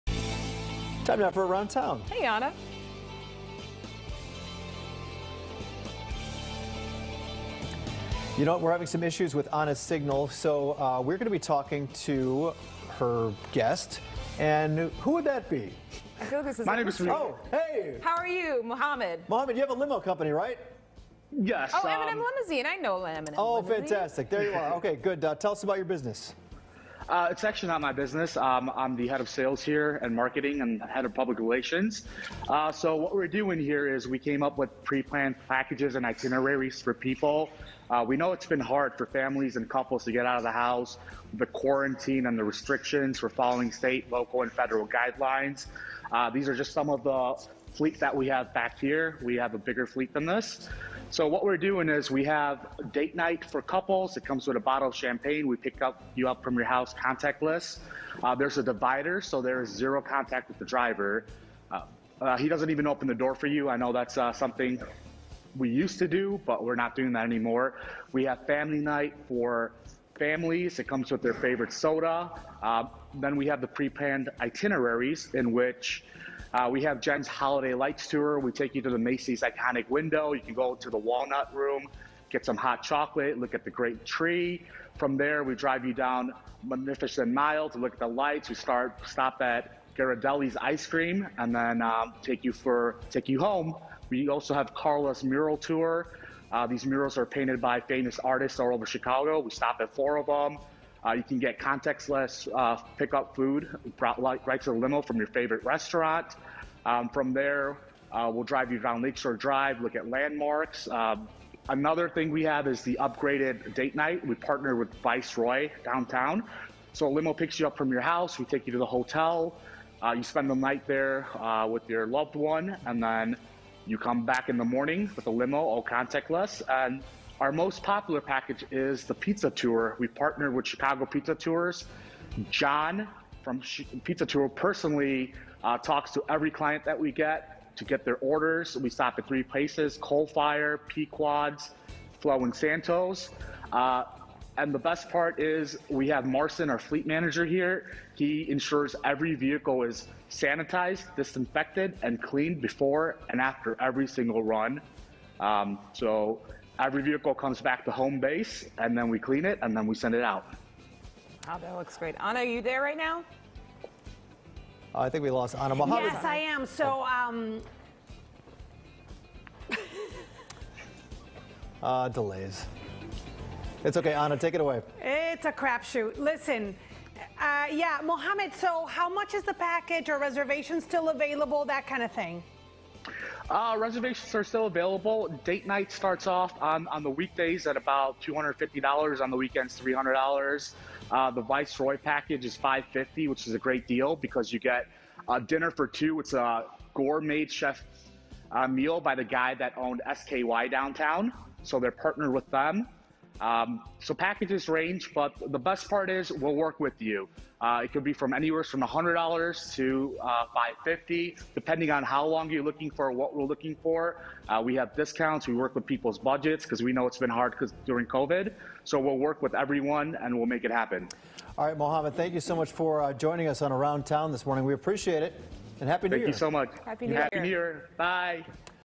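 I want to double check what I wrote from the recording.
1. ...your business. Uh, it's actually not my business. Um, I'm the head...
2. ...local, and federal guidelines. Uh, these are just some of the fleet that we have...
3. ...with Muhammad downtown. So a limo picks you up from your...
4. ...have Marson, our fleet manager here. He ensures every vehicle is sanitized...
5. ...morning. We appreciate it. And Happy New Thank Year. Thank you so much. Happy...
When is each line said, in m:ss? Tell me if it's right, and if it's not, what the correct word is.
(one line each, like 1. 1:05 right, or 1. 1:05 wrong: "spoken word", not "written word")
1. 0:25 right
2. 0:44 right
3. 1:54 wrong: "Viceroy", not "Muhammad"
4. 2:26 right
5. 3:44 right.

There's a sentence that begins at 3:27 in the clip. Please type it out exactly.
Uh, it could be from anywhere from $100 to uh, $550, depending on how long you're looking for, what we're looking for.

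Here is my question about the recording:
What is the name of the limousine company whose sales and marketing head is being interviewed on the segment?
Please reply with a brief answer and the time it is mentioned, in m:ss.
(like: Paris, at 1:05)
M&M Limousine, at 0:22.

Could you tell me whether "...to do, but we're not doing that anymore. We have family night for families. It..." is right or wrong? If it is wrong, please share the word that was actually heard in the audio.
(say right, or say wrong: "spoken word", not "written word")
right.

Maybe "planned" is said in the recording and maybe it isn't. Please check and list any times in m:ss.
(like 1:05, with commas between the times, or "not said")
0:34, 1:13.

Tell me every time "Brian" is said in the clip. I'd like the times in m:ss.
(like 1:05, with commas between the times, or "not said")
not said.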